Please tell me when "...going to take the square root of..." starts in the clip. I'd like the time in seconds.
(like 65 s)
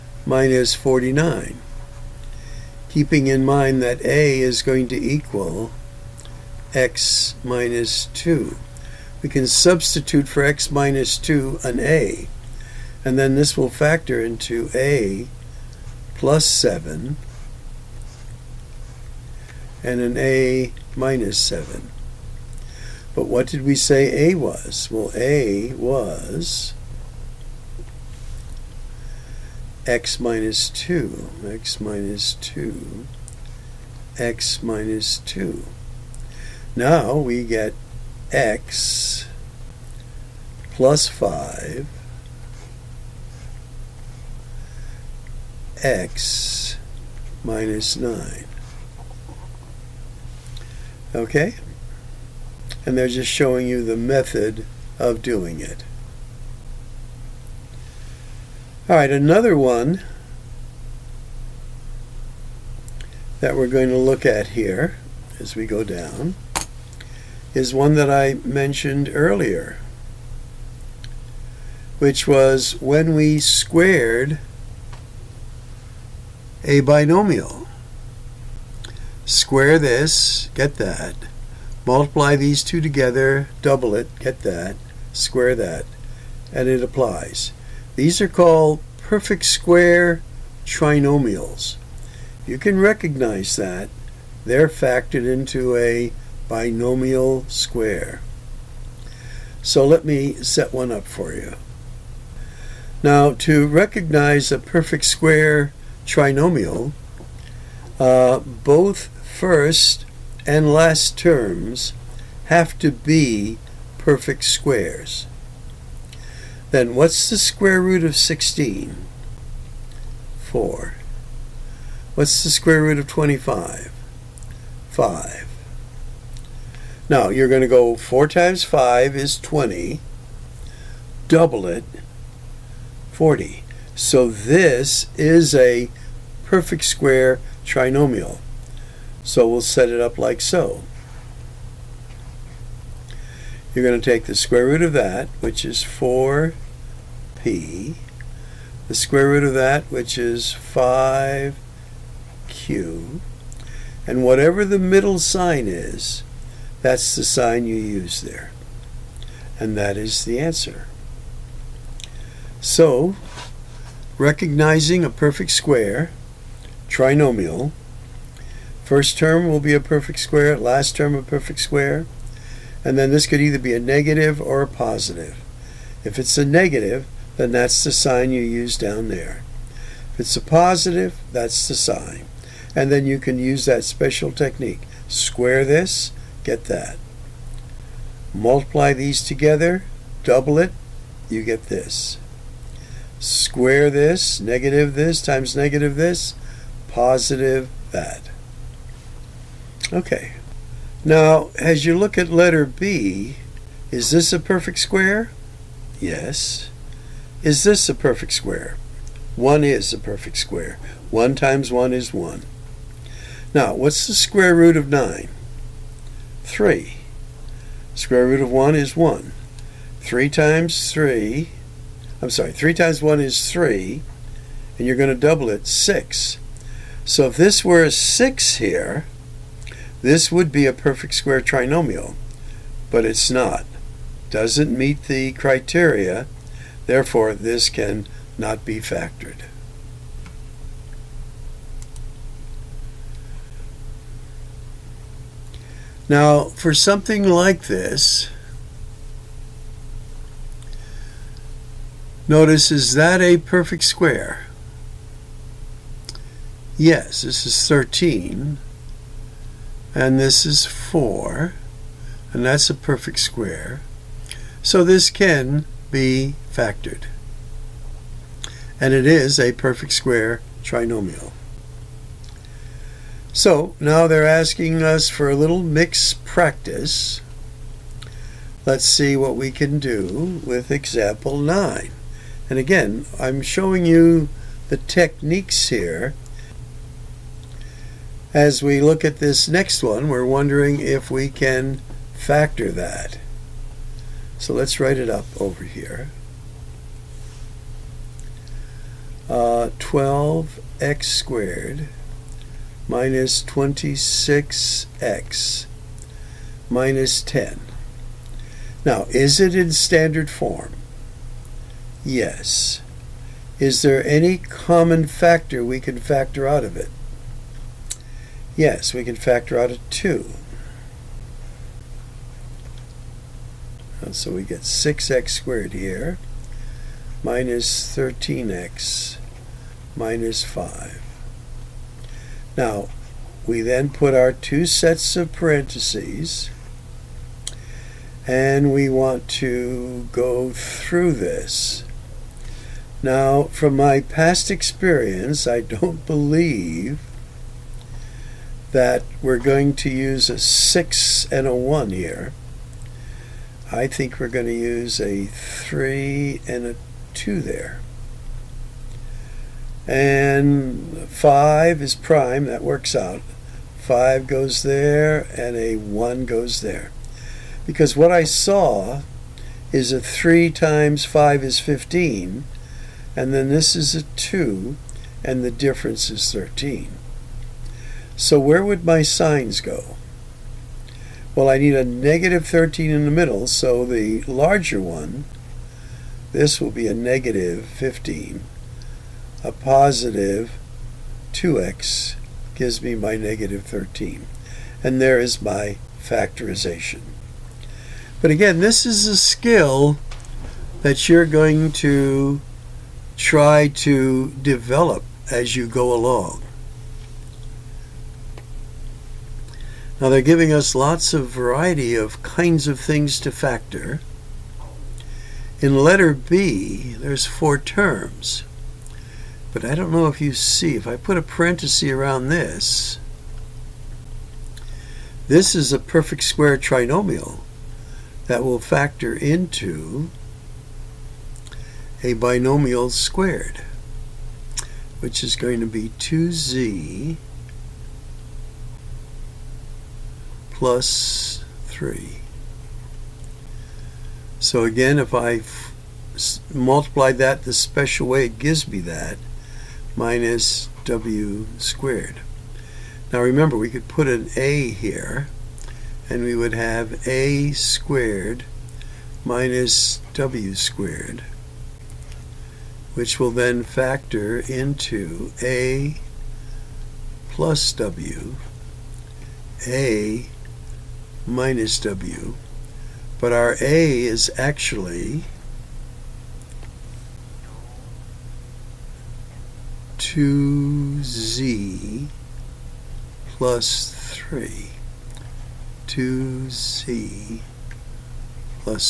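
143 s.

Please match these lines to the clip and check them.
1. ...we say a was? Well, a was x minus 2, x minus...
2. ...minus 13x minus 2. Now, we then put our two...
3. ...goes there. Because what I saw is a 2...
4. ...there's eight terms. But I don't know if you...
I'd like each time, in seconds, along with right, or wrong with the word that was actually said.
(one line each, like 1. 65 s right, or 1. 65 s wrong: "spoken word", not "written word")
1. 23 s right
2. 327 s wrong: "5", not "2"
3. 366 s wrong: "3", not "2"
4. 416 s wrong: "four", not "eight".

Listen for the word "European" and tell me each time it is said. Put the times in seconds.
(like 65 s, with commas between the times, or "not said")
not said.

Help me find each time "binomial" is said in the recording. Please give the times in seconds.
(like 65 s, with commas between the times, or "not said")
76 s, 96 s, 432 s.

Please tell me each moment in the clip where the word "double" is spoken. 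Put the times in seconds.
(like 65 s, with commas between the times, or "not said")
83 s, 131 s, 190 s, 225 s.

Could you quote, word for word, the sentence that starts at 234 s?
Doesn't meet the criteria Therefore, this can not be factored.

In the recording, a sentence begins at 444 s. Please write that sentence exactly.
So again, if I multiply that the special way, it gives me that minus w squared.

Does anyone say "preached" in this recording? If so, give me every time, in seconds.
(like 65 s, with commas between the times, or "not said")
not said.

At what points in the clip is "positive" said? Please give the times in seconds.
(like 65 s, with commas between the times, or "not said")
174 s, 180 s, 196 s, 389 s.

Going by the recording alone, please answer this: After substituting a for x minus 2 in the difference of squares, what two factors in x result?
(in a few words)
x + 5, x - 9.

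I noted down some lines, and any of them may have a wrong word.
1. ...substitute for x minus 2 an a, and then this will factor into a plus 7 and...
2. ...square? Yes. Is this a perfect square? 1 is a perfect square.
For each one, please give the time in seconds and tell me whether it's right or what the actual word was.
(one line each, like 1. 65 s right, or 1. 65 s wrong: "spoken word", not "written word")
1. 9 s right
2. 204 s right.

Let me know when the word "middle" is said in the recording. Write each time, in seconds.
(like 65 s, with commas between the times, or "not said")
154 s, 383 s.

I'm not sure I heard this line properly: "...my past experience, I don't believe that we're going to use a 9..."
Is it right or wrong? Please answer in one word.
wrong.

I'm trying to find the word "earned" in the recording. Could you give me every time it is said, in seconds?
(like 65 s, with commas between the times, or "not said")
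not said.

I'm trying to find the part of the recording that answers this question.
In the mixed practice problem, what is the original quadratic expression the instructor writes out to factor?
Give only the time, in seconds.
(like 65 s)
299 s.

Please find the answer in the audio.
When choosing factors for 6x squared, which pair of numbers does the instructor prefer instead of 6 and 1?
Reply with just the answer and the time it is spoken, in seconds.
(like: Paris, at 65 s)
3 and 2, at 355 s.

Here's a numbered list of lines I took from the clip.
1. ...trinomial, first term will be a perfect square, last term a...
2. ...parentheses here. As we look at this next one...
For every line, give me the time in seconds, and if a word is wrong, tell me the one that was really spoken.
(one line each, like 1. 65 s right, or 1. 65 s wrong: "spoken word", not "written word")
1. 166 s right
2. 284 s wrong: "techniques", not "parentheses".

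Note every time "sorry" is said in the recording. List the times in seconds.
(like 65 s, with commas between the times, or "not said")
222 s.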